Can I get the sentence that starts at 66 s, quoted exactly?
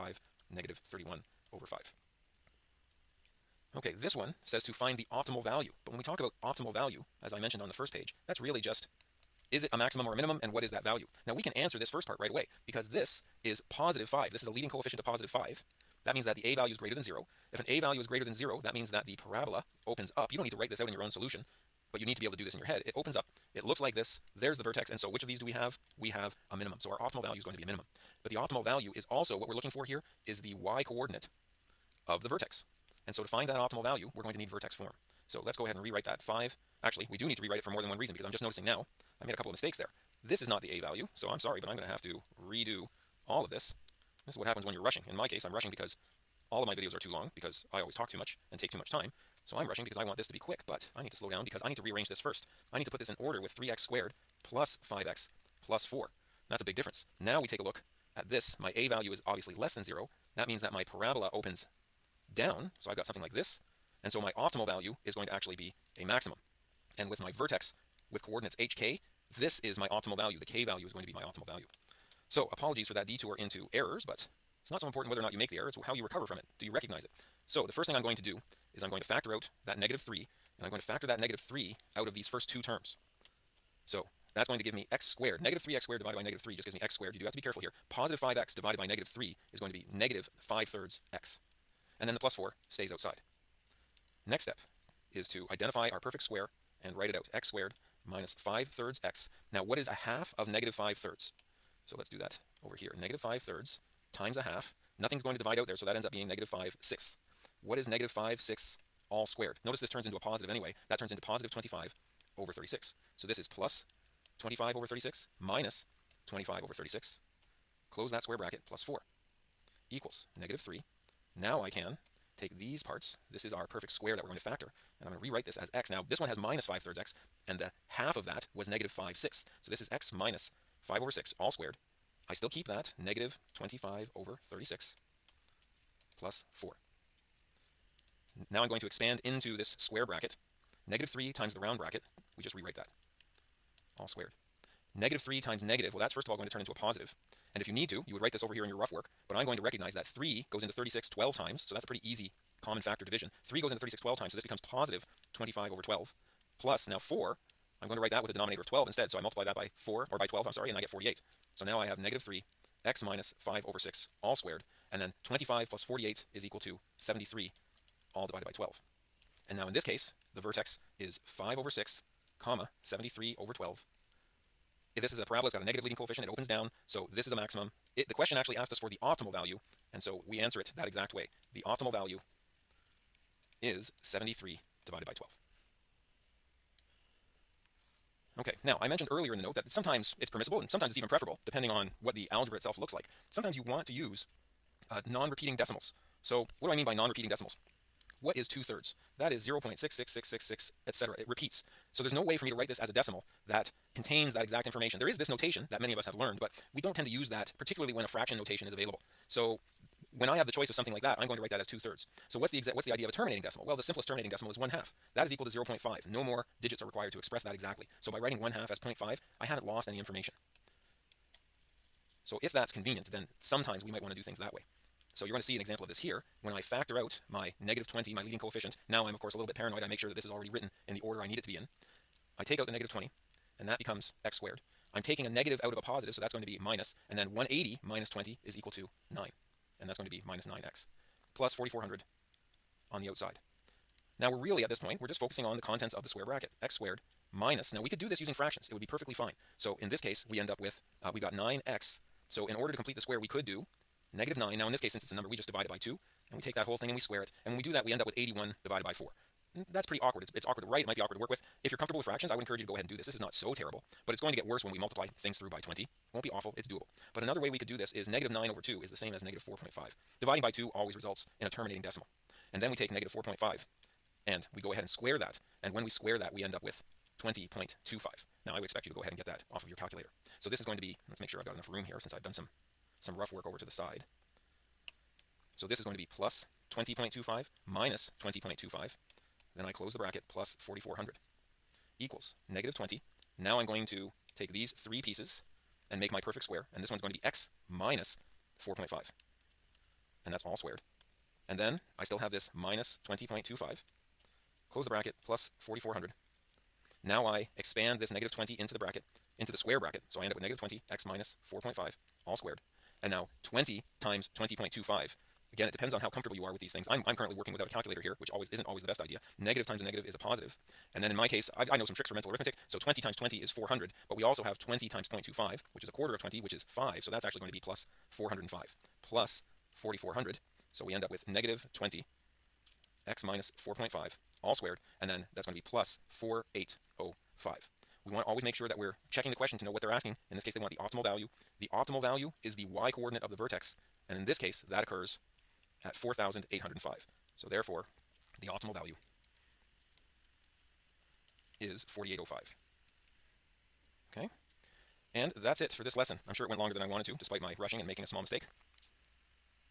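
And with my vertex with coordinates hk, this is my optimal value.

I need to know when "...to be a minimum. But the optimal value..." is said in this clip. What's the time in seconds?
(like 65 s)
27 s.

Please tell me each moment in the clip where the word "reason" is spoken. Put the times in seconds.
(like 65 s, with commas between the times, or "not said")
37 s.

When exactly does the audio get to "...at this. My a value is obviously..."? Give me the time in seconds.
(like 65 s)
58 s.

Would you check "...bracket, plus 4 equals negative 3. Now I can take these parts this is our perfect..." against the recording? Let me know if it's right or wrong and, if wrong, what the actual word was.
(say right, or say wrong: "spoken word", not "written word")
right.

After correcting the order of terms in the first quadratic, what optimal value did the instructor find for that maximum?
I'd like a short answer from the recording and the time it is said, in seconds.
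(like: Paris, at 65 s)
73/12, at 184 s.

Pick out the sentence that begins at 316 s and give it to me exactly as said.
I'm, I'm currently working without a calculator here, which always isn't always the best idea.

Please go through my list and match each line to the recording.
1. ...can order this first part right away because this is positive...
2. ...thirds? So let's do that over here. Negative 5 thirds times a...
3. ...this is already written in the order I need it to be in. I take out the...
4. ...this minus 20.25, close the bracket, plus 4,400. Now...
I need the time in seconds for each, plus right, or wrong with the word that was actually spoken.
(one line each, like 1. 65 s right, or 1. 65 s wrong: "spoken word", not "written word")
1. 11 s wrong: "answer", not "order"
2. 100 s right
3. 230 s right
4. 302 s right.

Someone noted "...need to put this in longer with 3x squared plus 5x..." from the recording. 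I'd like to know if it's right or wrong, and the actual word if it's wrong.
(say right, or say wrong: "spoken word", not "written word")
wrong: "order", not "longer".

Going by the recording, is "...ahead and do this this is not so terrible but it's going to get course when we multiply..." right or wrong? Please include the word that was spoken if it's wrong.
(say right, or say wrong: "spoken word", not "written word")
wrong: "worse", not "course".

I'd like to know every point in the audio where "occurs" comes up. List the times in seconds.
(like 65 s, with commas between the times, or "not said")
344 s.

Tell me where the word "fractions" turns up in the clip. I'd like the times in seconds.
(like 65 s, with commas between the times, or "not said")
208 s, 248 s, 262 s.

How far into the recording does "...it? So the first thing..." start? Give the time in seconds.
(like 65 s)
77 s.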